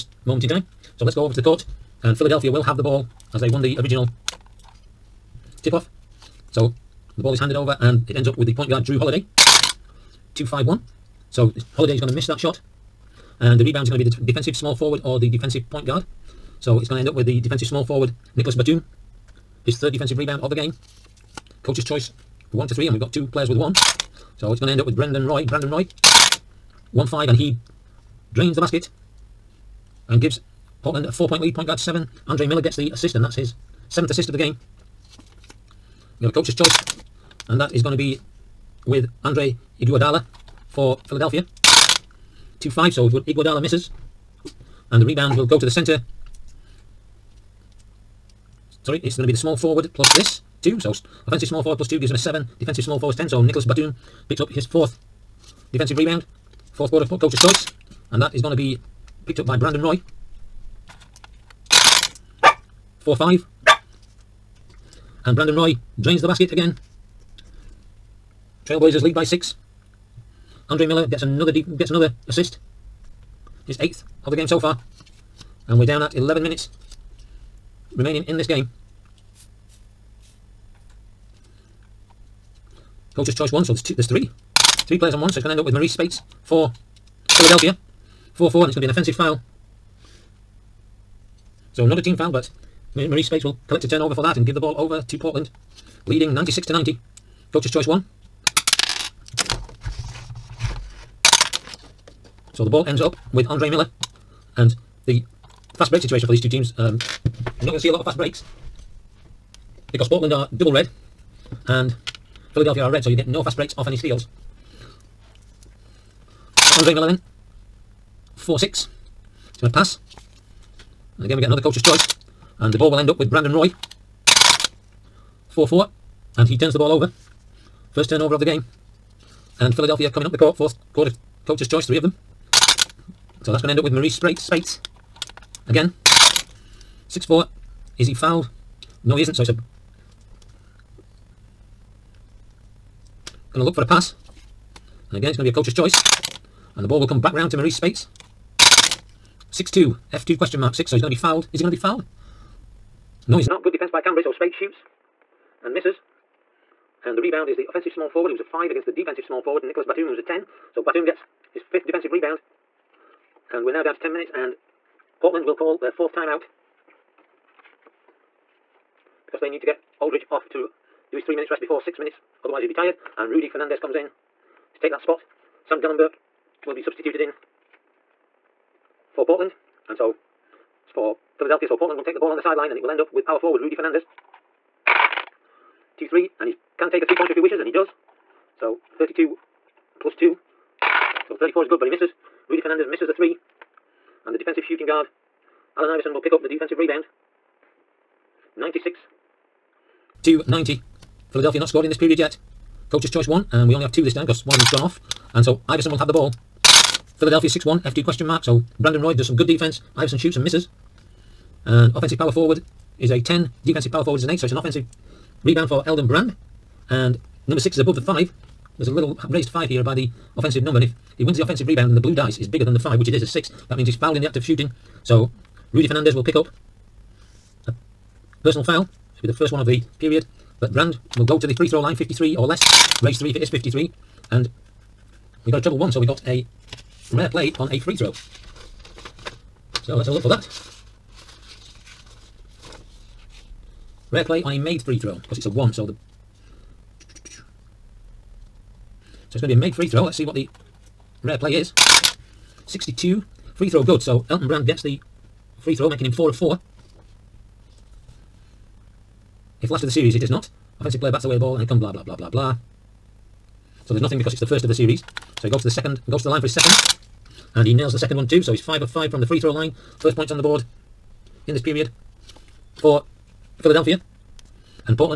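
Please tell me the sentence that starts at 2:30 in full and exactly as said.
So he's going to be fouled.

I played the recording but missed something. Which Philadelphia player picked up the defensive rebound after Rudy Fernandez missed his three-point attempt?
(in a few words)
Allen Iverson.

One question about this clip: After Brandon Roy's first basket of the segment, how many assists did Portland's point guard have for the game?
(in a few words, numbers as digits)
7.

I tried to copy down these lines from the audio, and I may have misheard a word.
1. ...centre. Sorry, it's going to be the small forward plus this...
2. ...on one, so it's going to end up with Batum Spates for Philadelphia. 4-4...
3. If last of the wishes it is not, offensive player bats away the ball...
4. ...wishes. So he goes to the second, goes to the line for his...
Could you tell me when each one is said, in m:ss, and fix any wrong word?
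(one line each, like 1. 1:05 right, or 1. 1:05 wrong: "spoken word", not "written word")
1. 0:45 right
2. 1:25 wrong: "Maurice", not "Batum"
3. 4:19 wrong: "series", not "wishes"
4. 4:24 wrong: "series", not "wishes".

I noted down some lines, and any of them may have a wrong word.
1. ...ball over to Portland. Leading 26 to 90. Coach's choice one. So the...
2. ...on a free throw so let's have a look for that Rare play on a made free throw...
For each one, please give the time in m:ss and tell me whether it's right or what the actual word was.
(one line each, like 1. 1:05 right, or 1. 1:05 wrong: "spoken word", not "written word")
1. 1:34 wrong: "96", not "26"
2. 3:57 right.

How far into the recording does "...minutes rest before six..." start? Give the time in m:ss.
2:51.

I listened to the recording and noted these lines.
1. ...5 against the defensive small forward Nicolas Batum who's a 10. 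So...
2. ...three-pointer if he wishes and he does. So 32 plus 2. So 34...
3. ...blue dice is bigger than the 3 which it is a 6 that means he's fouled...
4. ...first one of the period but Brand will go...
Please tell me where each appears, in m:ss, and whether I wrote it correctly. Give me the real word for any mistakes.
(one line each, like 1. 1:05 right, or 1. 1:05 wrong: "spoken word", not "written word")
1. 2:38 right
2. 3:07 right
3. 3:41 wrong: "5", not "3"
4. 3:49 right.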